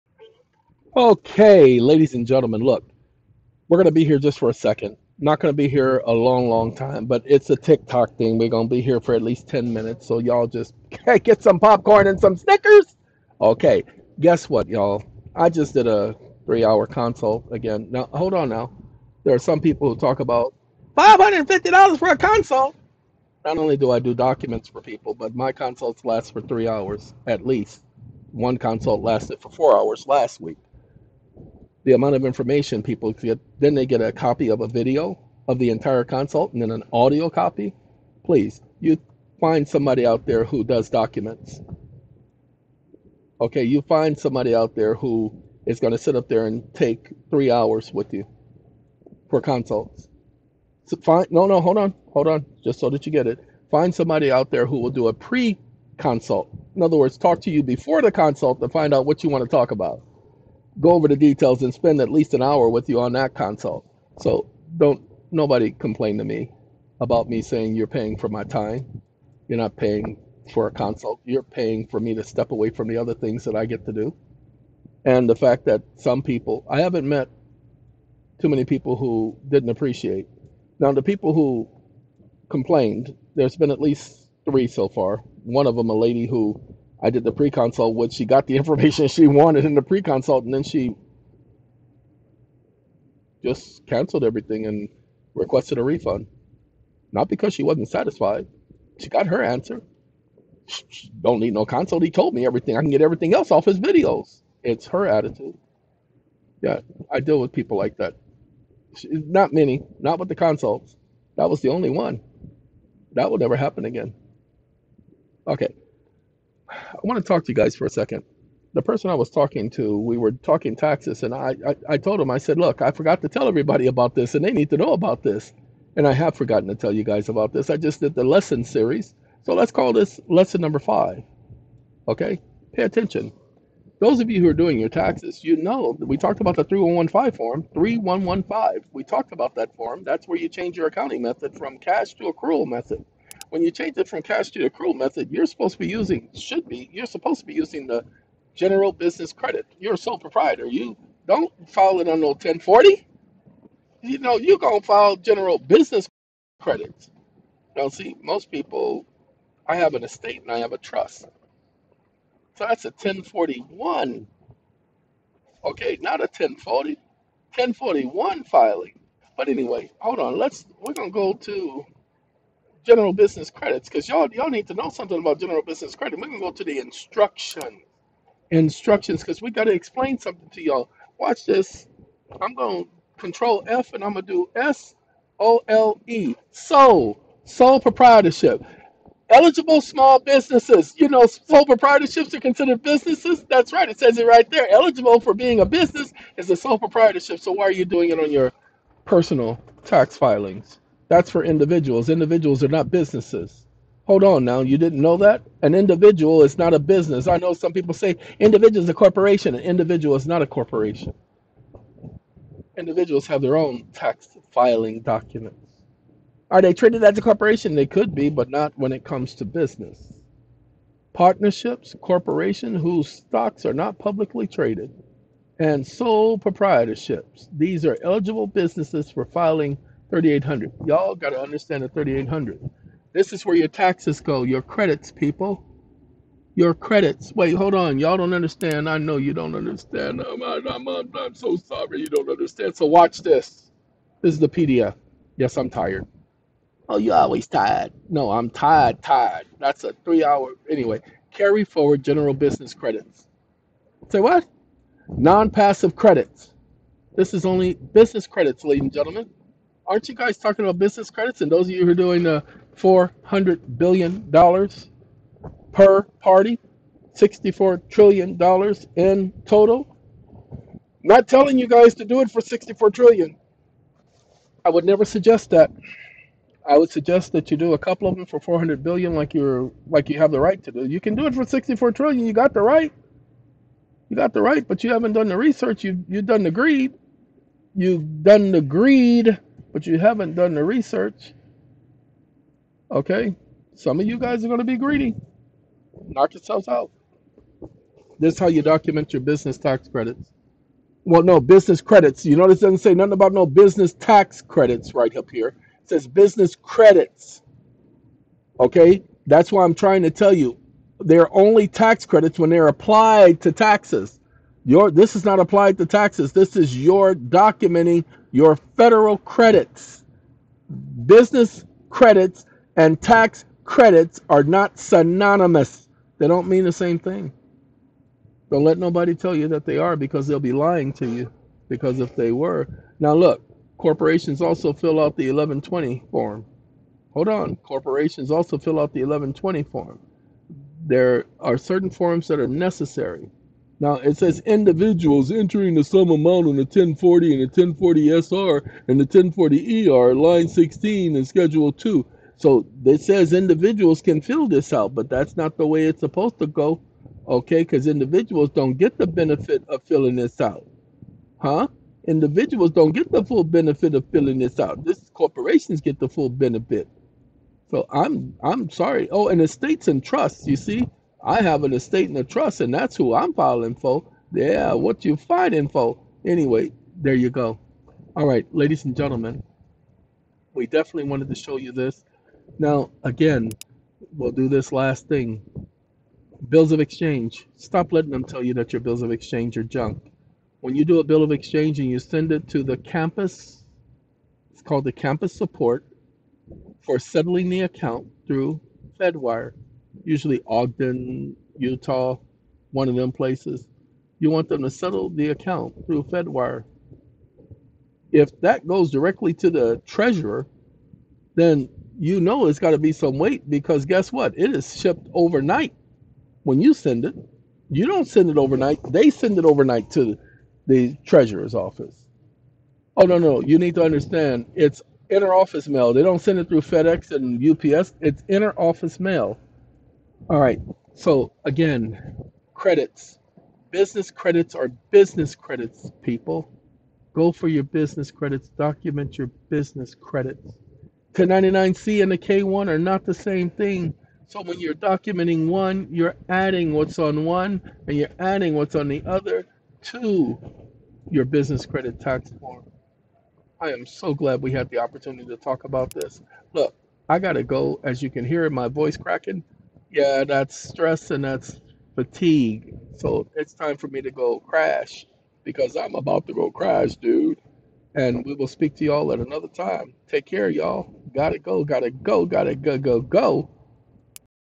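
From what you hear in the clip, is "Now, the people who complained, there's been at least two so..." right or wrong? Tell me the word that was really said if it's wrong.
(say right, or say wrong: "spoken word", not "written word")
wrong: "three", not "two".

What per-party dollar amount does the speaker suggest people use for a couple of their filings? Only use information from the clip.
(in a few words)
400 billion dollars.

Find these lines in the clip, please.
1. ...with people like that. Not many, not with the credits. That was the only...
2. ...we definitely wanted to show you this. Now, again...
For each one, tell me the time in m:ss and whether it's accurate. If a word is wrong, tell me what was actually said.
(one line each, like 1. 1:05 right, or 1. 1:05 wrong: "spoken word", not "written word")
1. 1:47 wrong: "consults", not "credits"
2. 6:20 right.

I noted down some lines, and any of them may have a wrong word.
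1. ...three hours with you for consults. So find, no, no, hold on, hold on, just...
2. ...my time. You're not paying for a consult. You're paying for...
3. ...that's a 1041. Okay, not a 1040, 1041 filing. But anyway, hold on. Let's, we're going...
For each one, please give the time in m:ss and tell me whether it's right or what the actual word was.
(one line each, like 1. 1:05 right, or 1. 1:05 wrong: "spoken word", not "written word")
1. 0:47 right
2. 1:08 right
3. 2:42 right.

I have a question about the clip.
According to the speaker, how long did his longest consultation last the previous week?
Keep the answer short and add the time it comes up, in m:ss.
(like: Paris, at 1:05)
4 hours, at 0:29.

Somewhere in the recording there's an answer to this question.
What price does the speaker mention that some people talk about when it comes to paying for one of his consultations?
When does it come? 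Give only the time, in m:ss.
0:20.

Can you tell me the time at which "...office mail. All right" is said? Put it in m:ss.
7:08.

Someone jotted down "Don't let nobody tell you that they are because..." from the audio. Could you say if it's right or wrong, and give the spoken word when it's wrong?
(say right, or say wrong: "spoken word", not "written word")
right.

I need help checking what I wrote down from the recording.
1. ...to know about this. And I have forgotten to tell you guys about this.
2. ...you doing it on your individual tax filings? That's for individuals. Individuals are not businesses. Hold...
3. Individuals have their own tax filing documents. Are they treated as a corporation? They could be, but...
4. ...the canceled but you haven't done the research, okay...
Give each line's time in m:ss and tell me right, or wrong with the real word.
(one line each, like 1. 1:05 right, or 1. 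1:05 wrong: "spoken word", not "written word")
1. 2:04 right
2. 3:17 wrong: "personal", not "individual"
3. 3:32 right
4. 4:48 wrong: "greed", not "canceled".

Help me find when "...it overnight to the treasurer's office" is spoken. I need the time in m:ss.
6:59.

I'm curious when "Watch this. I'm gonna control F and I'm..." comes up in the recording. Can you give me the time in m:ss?
3:01.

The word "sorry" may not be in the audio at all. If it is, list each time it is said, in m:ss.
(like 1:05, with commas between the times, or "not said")
4:01, 6:08.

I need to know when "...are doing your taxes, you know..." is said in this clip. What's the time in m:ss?
2:14.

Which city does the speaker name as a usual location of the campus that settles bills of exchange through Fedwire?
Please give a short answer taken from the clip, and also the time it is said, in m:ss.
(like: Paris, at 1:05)
Ogden, Utah, at 6:40.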